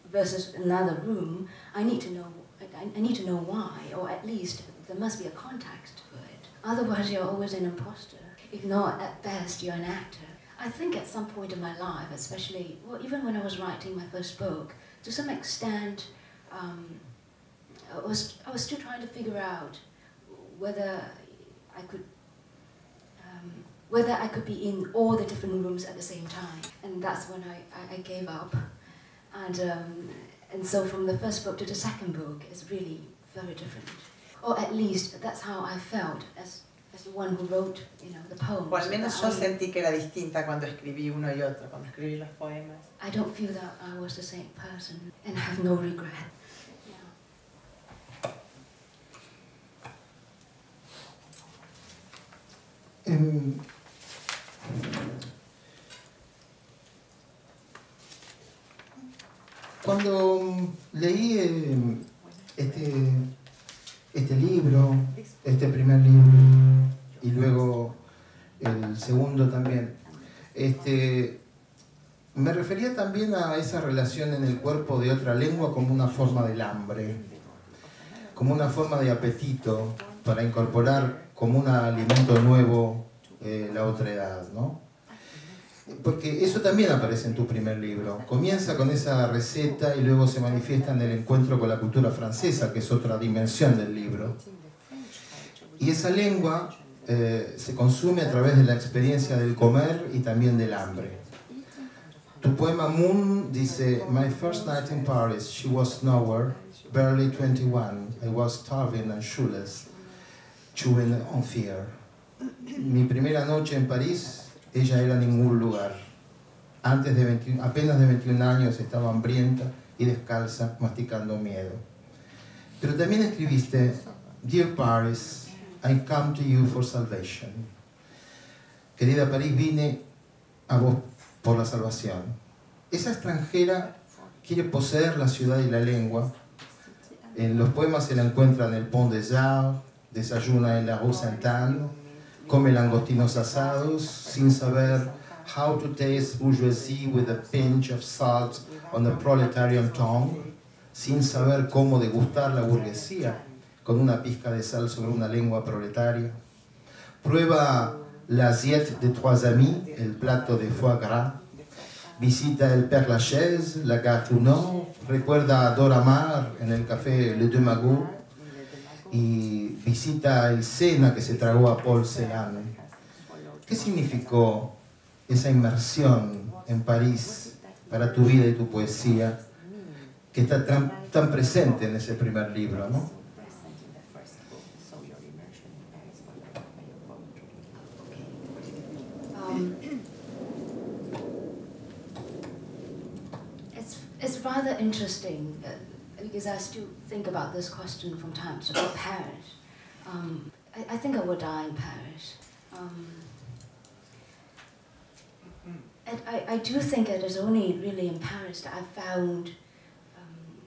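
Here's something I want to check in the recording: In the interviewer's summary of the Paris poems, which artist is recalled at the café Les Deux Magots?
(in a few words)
Dora Maar.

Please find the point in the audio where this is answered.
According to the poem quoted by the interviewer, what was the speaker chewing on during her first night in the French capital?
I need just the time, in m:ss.
1:50.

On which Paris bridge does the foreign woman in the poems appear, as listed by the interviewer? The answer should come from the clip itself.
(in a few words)
Pont des Arts.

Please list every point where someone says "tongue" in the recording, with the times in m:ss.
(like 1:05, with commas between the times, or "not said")
2:29.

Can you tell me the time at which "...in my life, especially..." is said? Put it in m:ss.
0:11.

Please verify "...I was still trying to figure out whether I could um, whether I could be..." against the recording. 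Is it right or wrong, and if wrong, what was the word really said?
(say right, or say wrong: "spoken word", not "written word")
right.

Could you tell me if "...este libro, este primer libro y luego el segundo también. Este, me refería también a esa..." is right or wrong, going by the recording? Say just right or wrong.
right.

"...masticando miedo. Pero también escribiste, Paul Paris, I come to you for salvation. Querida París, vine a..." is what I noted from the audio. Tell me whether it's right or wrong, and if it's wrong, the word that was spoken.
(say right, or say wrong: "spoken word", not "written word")
wrong: "Dear", not "Paul".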